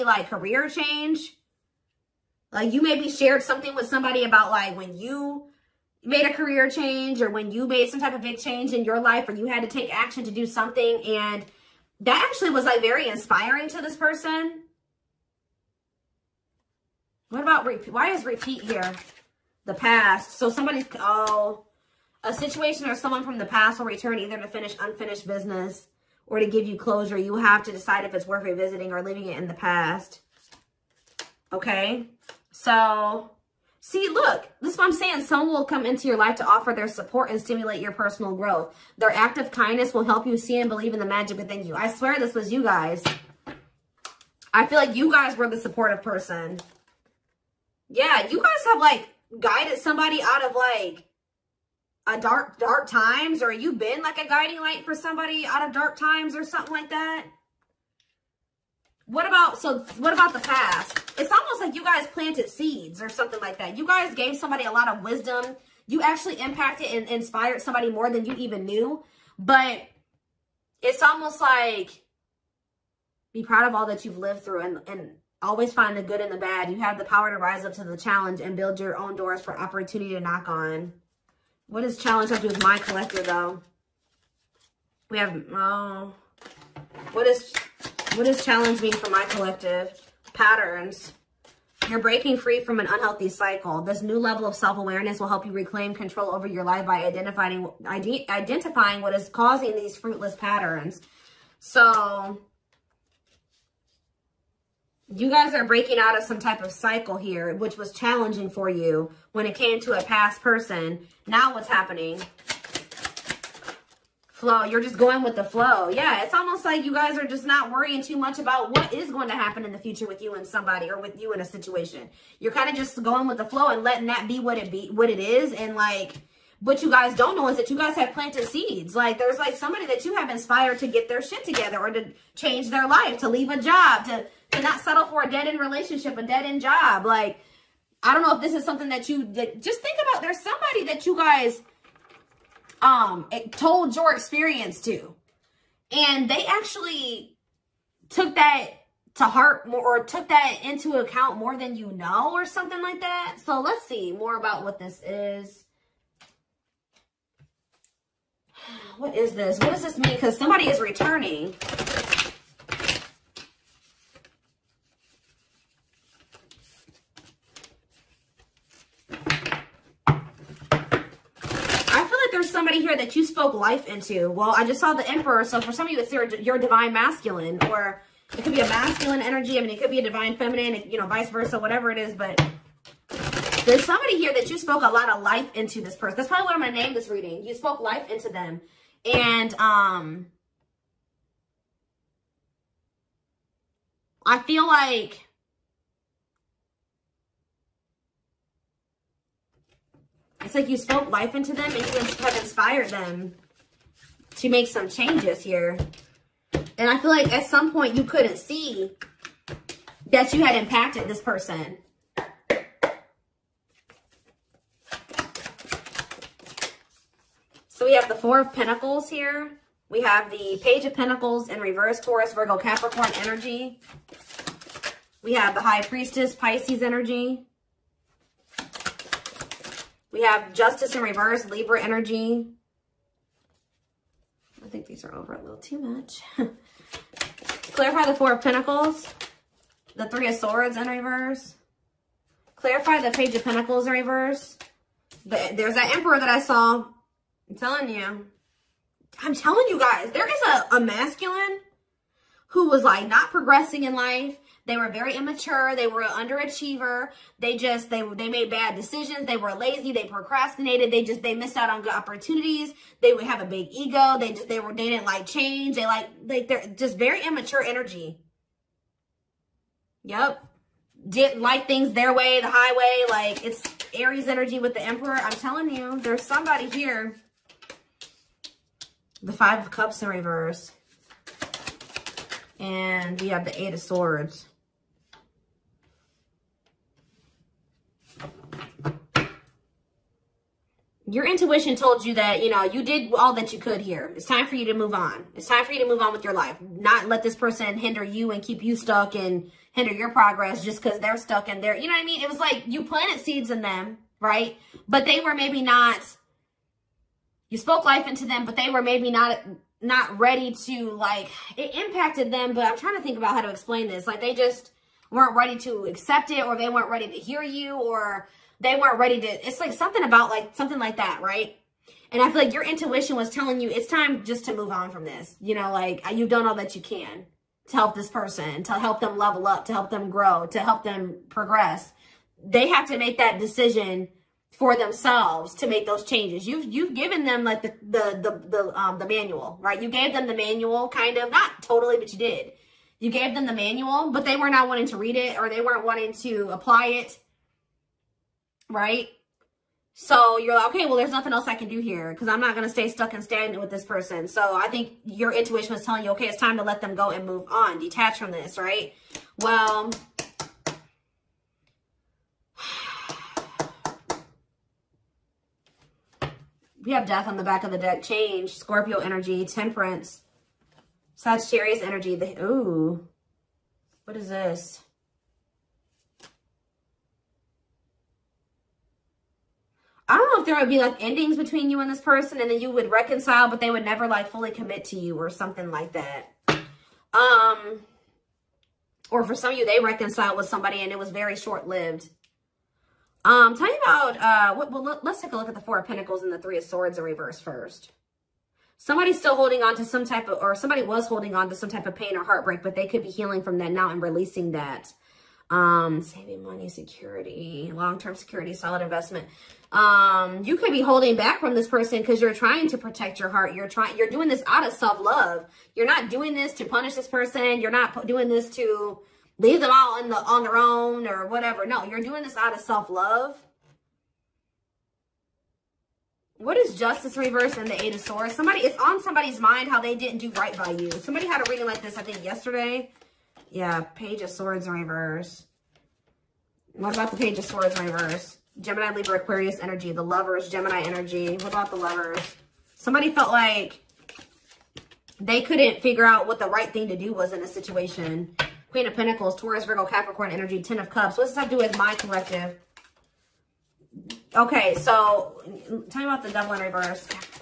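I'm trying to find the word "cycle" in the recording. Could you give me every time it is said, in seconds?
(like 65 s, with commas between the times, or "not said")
93 s, 106 s.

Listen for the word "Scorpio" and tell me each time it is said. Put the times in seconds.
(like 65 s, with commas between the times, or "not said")
368 s.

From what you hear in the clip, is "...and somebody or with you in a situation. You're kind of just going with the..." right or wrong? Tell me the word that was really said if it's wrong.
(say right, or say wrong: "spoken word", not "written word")
right.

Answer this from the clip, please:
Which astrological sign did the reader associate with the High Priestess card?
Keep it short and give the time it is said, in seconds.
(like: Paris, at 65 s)
Pisces, at 226 s.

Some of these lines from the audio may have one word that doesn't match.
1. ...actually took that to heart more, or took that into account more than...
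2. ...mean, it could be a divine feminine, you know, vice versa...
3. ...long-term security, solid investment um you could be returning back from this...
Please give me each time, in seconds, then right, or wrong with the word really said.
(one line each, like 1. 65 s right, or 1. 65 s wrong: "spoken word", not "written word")
1. 146 s right
2. 179 s right
3. 407 s wrong: "holding", not "returning".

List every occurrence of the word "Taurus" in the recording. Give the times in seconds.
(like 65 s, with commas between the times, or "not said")
221 s, 449 s.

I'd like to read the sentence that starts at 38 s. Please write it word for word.
Their act of kindness will help you see and believe in the magic within you.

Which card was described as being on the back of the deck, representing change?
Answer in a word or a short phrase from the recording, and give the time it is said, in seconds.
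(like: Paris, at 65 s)
Death, at 367 s.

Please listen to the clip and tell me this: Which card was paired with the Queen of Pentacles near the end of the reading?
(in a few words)
Ten of Cups.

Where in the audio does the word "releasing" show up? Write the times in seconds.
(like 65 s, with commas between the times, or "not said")
403 s.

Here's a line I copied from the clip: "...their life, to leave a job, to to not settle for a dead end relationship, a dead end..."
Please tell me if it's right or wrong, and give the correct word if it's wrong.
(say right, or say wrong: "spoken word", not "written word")
right.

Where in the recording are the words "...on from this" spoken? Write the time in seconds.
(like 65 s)
324 s.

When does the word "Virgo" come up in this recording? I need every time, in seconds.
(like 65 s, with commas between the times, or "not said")
222 s, 449 s.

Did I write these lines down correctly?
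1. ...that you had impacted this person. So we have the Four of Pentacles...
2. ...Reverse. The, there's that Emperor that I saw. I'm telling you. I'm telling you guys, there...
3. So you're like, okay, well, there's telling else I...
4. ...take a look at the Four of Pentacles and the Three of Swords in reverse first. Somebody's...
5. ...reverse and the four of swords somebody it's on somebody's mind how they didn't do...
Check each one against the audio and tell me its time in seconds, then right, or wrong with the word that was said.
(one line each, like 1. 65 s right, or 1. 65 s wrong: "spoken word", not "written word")
1. 210 s right
2. 243 s right
3. 349 s wrong: "nothing", not "telling"
4. 395 s right
5. 427 s wrong: "eight", not "four".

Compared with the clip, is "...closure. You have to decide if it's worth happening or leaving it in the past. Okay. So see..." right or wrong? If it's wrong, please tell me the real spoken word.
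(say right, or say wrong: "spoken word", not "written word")
wrong: "revisiting", not "happening".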